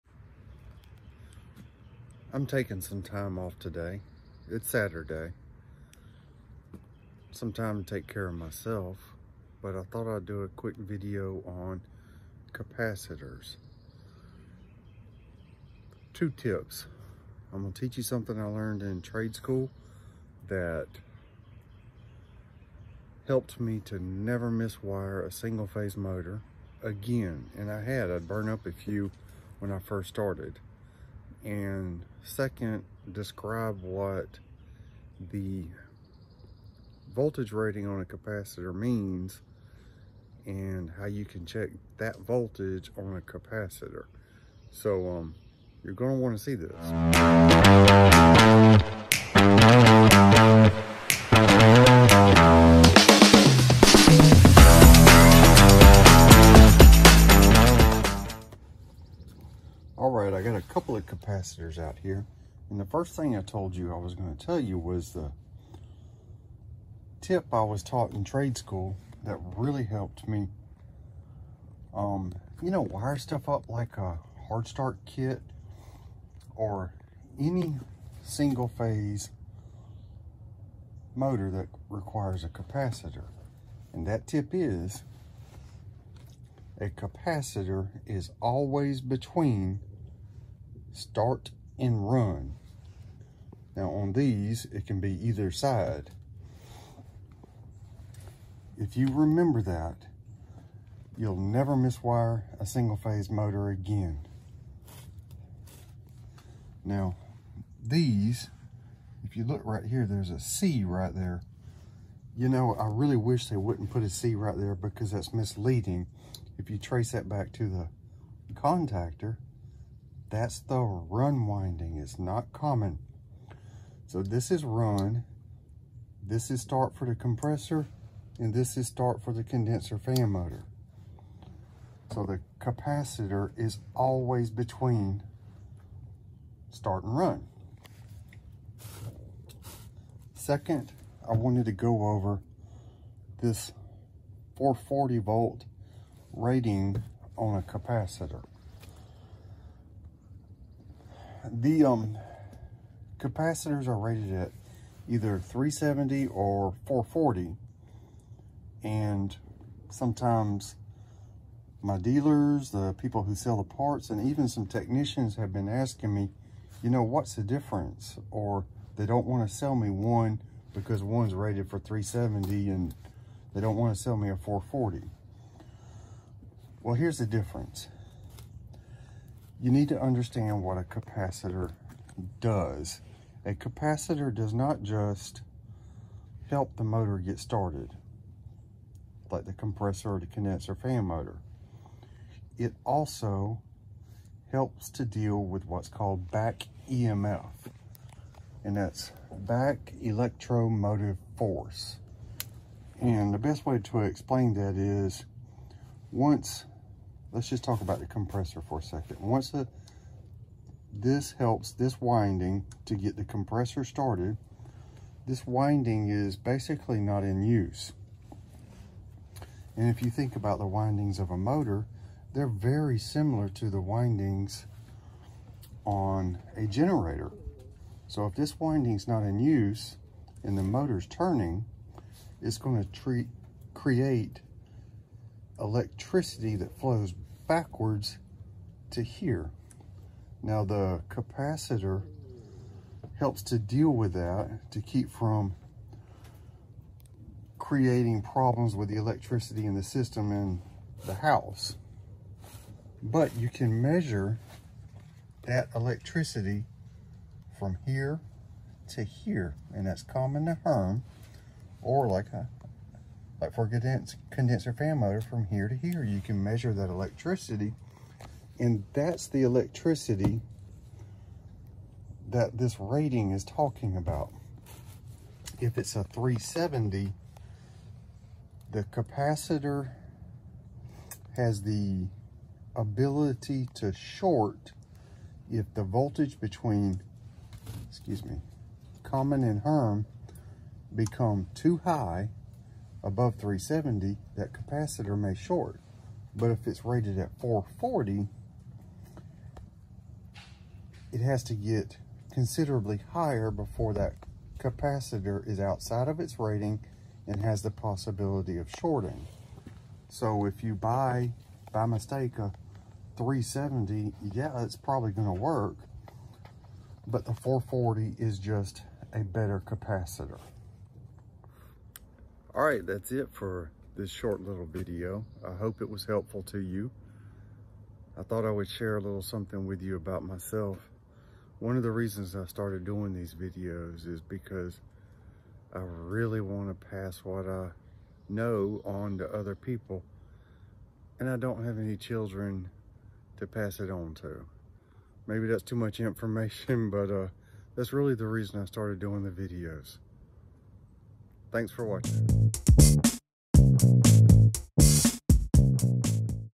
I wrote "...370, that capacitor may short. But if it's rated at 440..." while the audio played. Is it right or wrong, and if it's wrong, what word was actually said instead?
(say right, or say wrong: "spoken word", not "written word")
right.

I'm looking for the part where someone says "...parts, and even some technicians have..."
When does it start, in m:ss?
2:43.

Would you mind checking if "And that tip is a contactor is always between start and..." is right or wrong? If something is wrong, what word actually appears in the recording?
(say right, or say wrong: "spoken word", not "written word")
wrong: "capacitor", not "contactor".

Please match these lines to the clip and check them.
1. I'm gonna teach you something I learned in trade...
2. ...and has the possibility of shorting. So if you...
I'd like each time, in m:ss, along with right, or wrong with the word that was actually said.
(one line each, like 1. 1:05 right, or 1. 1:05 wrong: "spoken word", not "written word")
1. 0:17 right
2. 5:07 right.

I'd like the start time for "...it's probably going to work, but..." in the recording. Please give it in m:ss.
5:14.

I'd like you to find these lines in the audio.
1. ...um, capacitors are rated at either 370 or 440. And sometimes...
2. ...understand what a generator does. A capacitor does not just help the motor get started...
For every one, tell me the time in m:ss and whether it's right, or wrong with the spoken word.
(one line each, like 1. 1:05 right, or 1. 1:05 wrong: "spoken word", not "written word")
1. 2:31 right
2. 3:00 wrong: "capacitor", not "generator".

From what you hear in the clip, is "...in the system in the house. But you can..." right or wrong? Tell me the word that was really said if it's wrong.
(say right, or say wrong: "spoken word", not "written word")
right.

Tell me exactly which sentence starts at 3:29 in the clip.
Once the, this helps this winding to get the compressor started, this winding is basically not in use.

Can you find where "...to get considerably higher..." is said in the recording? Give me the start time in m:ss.
5:01.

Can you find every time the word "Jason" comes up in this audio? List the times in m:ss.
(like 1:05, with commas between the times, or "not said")
not said.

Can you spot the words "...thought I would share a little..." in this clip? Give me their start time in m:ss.
5:28.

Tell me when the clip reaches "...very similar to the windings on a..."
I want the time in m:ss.
3:42.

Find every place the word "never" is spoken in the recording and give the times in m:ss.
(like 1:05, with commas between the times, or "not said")
0:24, 1:41.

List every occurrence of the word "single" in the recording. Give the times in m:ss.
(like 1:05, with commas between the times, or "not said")
0:25, 1:18, 1:42.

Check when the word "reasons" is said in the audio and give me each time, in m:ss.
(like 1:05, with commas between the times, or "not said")
5:31, 5:48.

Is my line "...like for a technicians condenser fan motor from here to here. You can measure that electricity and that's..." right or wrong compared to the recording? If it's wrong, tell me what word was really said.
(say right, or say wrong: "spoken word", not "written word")
wrong: "condens", not "technicians".